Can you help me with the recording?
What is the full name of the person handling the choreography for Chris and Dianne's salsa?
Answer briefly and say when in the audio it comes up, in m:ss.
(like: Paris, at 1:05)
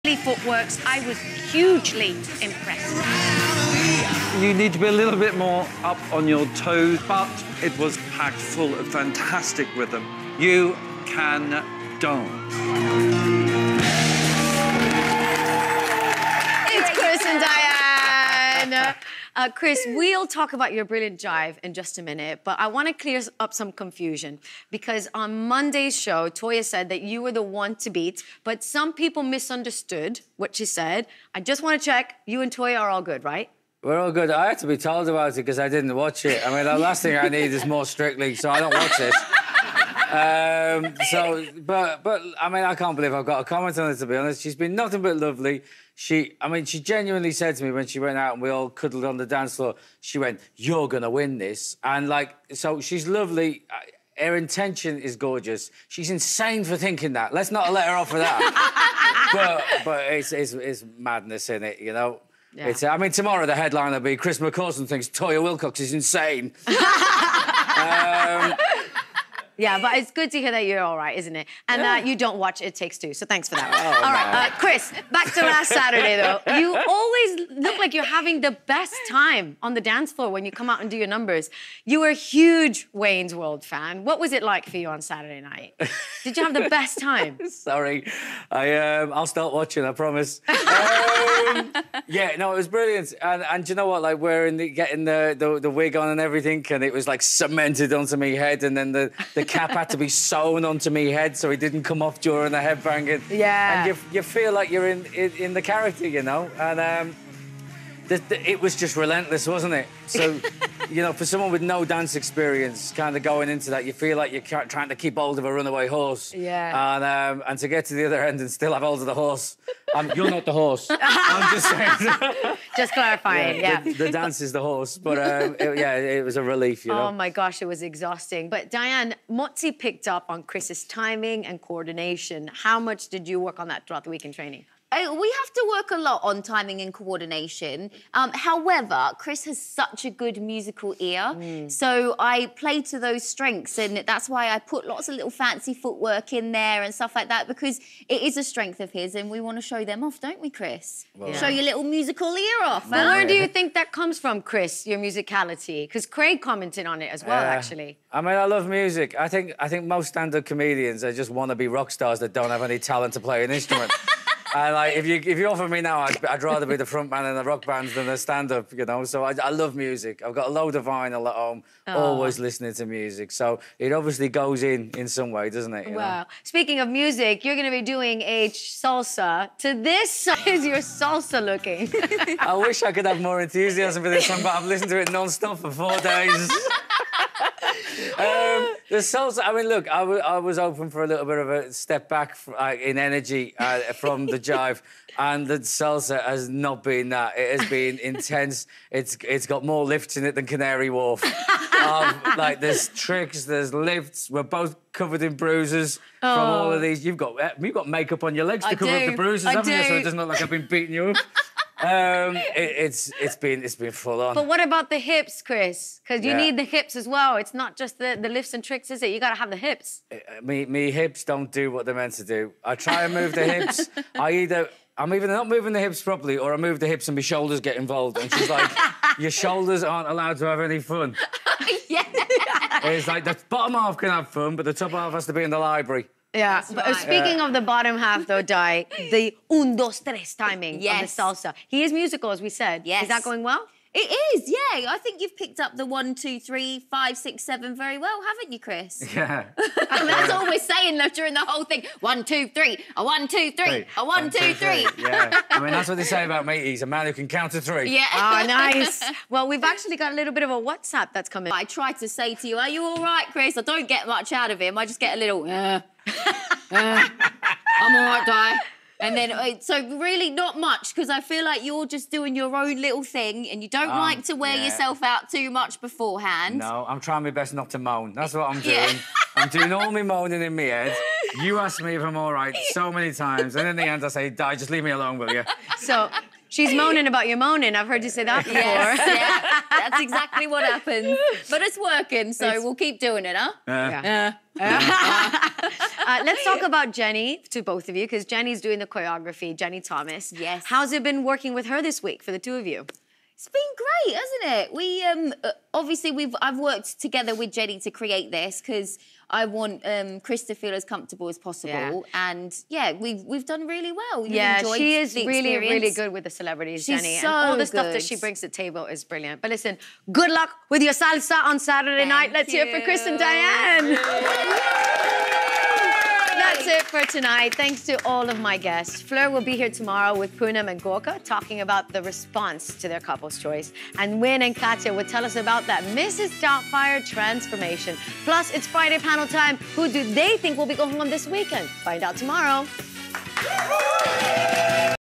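Jenny Thomas, at 4:59.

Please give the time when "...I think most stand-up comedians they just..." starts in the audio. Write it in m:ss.
2:39.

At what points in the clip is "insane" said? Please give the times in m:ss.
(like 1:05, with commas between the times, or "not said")
0:56, 1:05.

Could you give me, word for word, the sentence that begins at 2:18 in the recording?
Um, however, Chris has such a good musical ear, mm.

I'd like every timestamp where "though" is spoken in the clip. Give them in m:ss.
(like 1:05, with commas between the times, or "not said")
1:16, 3:58, 4:10.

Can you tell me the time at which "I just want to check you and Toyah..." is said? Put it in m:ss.
0:31.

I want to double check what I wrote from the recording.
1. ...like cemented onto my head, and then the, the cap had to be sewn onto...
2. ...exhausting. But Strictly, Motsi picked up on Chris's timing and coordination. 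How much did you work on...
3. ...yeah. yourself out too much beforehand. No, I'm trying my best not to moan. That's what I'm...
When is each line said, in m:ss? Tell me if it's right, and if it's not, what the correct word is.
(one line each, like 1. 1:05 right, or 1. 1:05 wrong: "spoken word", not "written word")
1. 1:37 right
2. 2:07 wrong: "Dianne", not "Strictly"
3. 4:34 right.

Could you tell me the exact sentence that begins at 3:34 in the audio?
But what about the hips, Chris?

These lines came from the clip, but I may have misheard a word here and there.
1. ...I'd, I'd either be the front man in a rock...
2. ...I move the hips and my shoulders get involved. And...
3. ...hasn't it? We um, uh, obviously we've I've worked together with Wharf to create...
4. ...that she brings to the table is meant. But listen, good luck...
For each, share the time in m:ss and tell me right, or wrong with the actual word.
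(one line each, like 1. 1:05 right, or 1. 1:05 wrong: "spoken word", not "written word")
1. 2:46 wrong: "rather", not "either"
2. 3:46 right
3. 5:04 wrong: "Jenny", not "Wharf"
4. 5:17 wrong: "brilliant", not "meant".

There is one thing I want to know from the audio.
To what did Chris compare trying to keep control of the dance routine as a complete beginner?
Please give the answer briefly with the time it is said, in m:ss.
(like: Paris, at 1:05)
A runaway horse, at 1:55.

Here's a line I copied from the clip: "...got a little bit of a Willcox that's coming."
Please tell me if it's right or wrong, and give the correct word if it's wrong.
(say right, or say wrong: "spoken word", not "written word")
wrong: "WhatsApp", not "Willcox".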